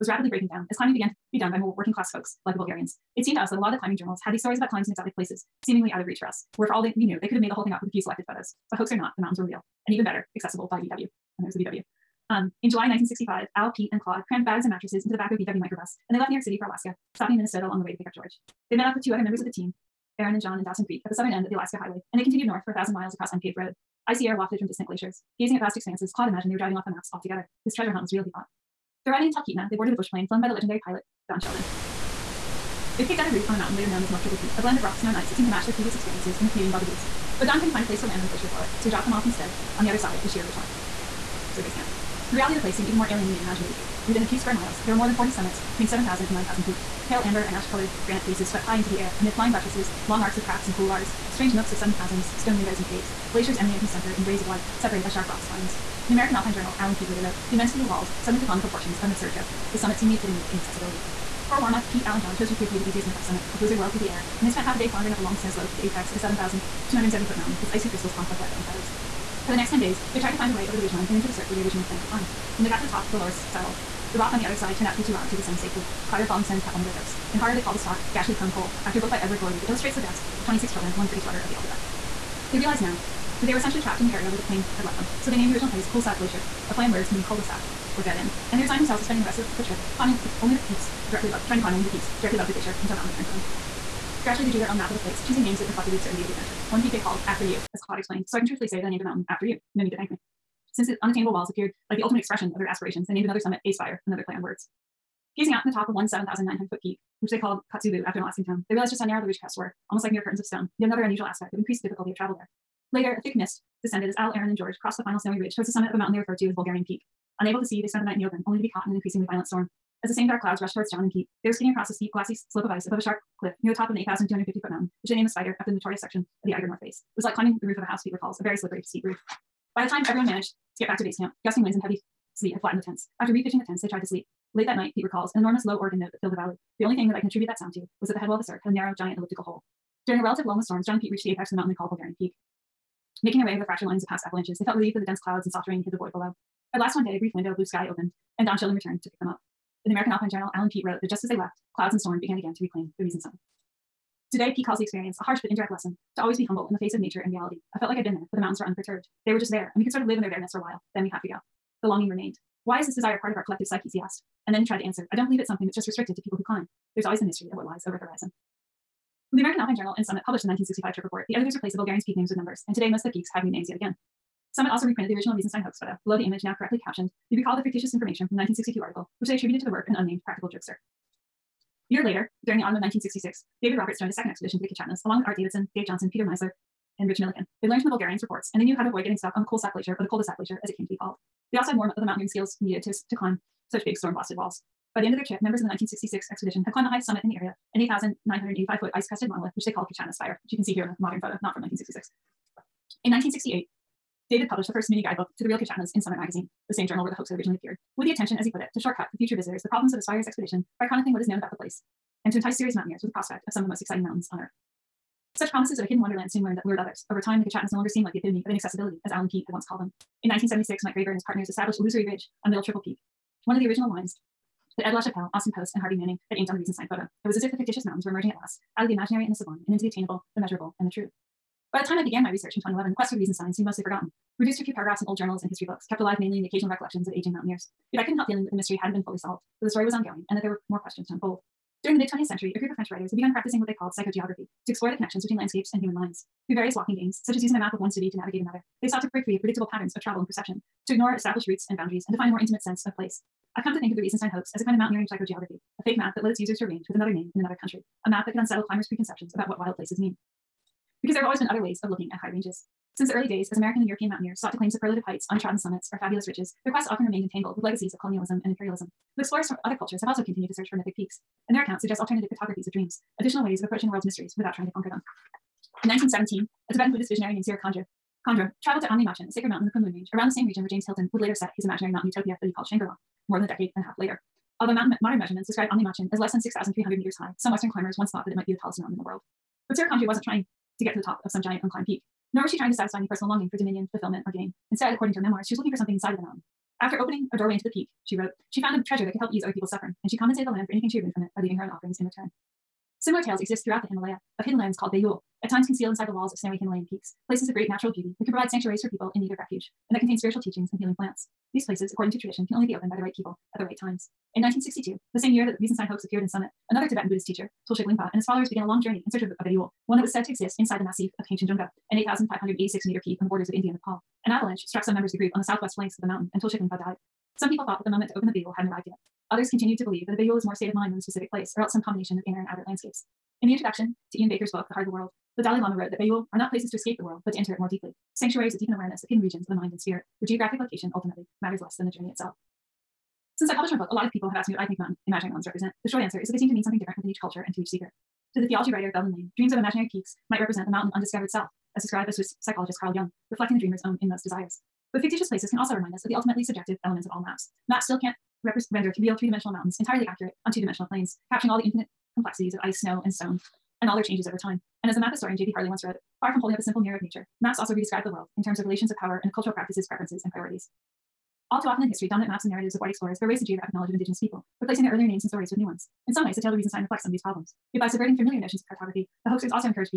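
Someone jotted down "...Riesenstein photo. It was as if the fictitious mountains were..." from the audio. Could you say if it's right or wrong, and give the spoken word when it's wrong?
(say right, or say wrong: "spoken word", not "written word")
right.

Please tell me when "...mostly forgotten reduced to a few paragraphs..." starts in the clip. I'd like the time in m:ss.
3:53.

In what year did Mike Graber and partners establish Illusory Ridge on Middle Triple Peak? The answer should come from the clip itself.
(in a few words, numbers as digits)
1976.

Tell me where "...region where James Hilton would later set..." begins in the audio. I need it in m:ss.
4:40.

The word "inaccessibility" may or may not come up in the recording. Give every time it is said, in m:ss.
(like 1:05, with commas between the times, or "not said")
1:00, 3:38.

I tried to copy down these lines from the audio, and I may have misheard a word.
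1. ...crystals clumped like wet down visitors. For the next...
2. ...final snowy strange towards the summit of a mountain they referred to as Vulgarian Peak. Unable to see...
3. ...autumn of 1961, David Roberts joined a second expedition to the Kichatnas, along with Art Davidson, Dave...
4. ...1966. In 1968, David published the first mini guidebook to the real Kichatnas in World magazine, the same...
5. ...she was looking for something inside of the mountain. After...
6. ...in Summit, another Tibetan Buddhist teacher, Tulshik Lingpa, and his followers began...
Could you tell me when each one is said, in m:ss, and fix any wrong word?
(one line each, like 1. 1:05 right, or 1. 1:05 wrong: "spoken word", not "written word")
1. 1:07 wrong: "feathers", not "visitors"
2. 1:55 wrong: "ridge", not "strange"
3. 3:02 wrong: "1966", not "1961"
4. 3:21 wrong: "Summit", not "World"
5. 4:55 right
6. 5:16 right.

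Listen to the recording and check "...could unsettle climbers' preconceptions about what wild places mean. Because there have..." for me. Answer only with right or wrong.
right.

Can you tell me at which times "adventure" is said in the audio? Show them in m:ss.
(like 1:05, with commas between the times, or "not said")
1:36.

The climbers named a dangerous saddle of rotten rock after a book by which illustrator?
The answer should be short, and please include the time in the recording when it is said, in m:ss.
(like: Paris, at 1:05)
Edward Gorey, at 1:19.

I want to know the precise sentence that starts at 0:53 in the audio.
Glaciers emanate from the center in rays of white, separated by sharp rock spines.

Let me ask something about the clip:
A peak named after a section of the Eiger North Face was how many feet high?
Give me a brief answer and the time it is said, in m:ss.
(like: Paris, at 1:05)
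8,250 feet, at 2:03.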